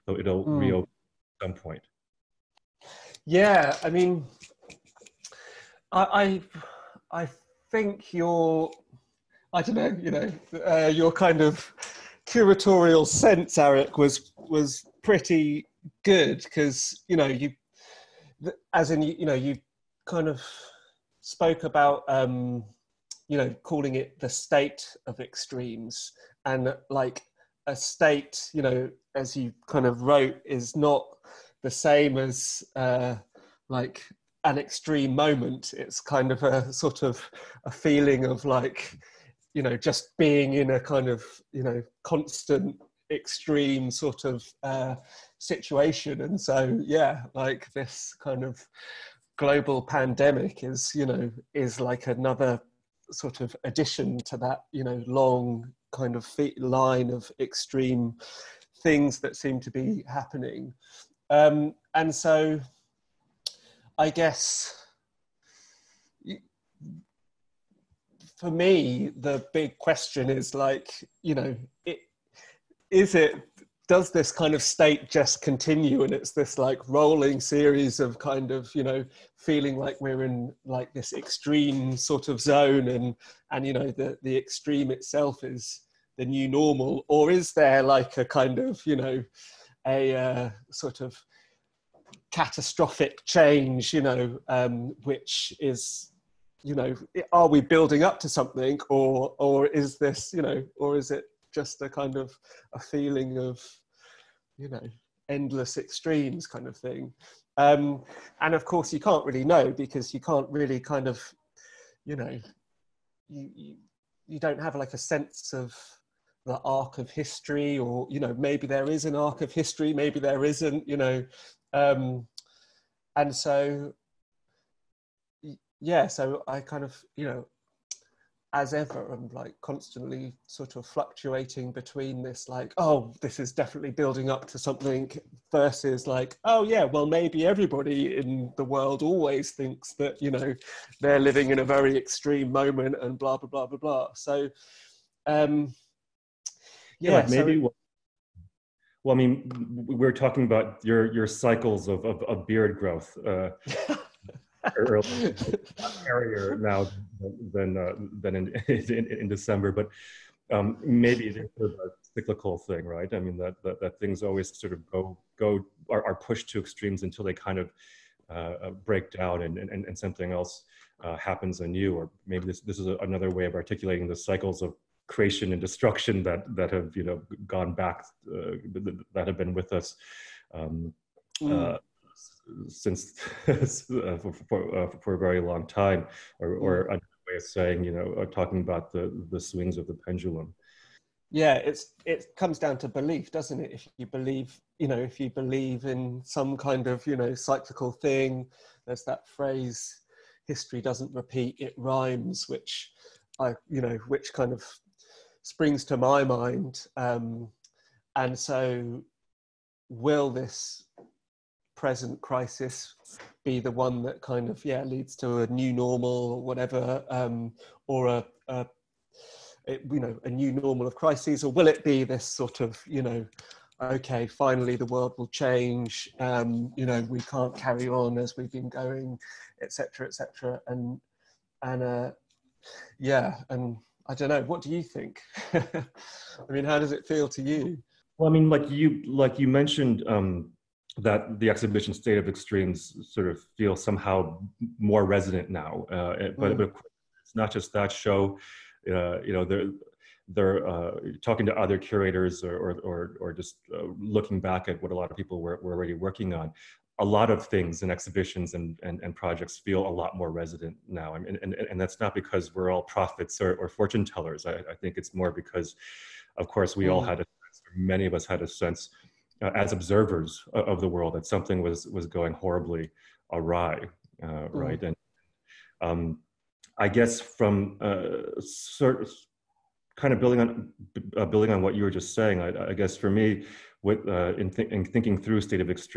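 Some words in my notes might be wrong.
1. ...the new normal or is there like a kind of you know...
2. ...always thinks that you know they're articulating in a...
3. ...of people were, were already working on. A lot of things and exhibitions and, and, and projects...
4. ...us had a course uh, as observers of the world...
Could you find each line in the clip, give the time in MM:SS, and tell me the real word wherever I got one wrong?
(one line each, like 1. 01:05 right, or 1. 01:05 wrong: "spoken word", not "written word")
1. 01:26 right
2. 02:19 wrong: "living", not "articulating"
3. 04:15 right
4. 04:28 wrong: "sense", not "course".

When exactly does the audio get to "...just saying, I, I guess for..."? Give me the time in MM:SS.
04:41.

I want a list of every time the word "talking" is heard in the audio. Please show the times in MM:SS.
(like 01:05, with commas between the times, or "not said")
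02:30, 03:08, 04:11.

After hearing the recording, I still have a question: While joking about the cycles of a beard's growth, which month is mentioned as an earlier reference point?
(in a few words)
December.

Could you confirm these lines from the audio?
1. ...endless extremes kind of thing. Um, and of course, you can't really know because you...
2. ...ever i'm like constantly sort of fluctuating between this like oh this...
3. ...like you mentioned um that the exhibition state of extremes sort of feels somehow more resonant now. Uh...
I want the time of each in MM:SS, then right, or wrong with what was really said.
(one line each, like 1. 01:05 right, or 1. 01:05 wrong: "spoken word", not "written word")
1. 01:45 right
2. 02:08 right
3. 03:59 right.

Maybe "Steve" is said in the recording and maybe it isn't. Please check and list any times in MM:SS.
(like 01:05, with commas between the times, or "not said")
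not said.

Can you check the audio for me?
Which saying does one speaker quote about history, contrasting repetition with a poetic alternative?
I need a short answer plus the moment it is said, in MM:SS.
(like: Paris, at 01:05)
history doesn't repeat, it rhymes, at 03:20.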